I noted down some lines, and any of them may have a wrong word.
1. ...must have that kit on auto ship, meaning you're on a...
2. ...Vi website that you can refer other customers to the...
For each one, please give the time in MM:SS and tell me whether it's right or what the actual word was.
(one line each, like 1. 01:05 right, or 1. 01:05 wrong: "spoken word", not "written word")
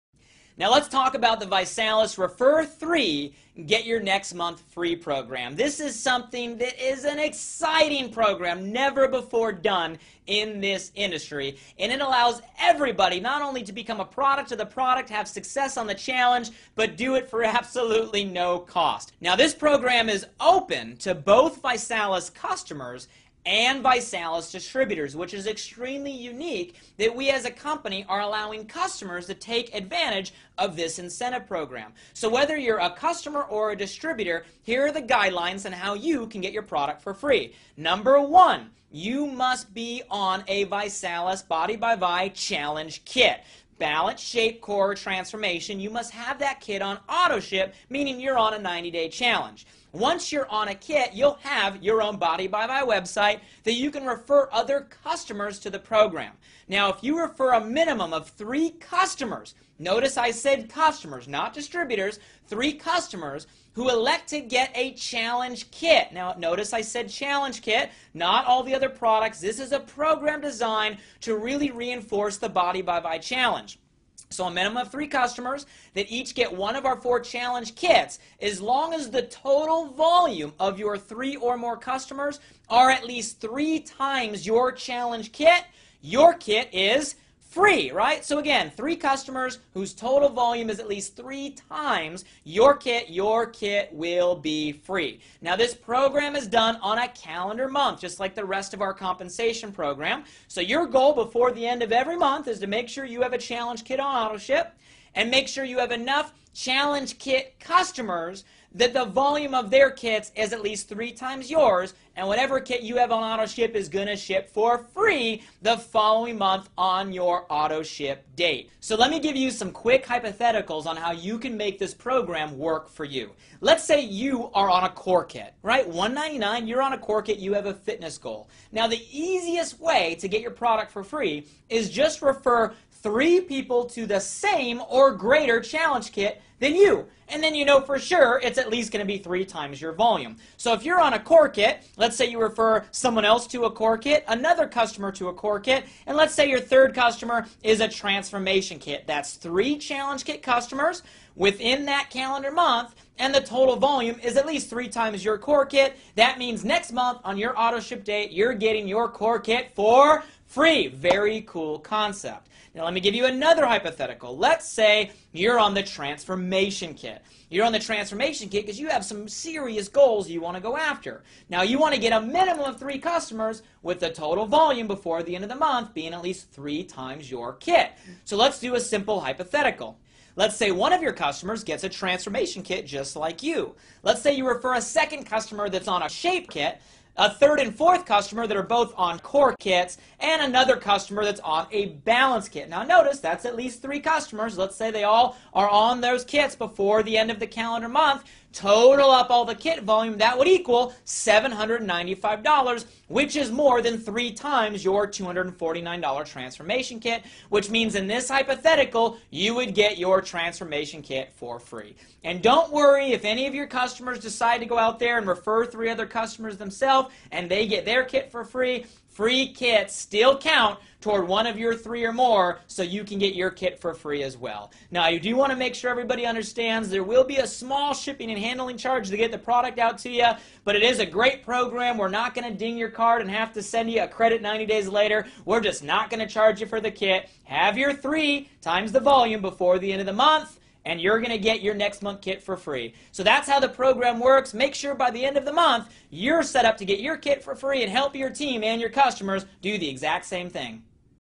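1. 00:45 right
2. 00:52 right.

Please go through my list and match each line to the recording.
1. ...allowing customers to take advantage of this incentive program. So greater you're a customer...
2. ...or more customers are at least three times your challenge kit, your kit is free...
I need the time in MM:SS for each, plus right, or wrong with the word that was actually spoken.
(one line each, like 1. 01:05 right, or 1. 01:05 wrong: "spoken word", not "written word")
1. 00:28 wrong: "whether", not "greater"
2. 01:21 right.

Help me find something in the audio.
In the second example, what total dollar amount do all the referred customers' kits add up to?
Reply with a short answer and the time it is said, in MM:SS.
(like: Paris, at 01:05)
$795, at 03:21.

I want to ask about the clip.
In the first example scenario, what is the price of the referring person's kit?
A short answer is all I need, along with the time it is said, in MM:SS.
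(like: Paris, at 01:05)
199, at 02:05.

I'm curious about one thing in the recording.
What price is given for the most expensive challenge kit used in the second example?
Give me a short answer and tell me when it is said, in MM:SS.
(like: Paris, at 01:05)
$249, at 03:25.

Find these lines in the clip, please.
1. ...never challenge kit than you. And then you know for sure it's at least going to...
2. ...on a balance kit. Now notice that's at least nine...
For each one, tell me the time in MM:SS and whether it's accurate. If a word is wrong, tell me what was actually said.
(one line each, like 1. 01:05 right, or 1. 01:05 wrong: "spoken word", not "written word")
1. 02:15 wrong: "greater", not "never"
2. 03:11 wrong: "three", not "nine".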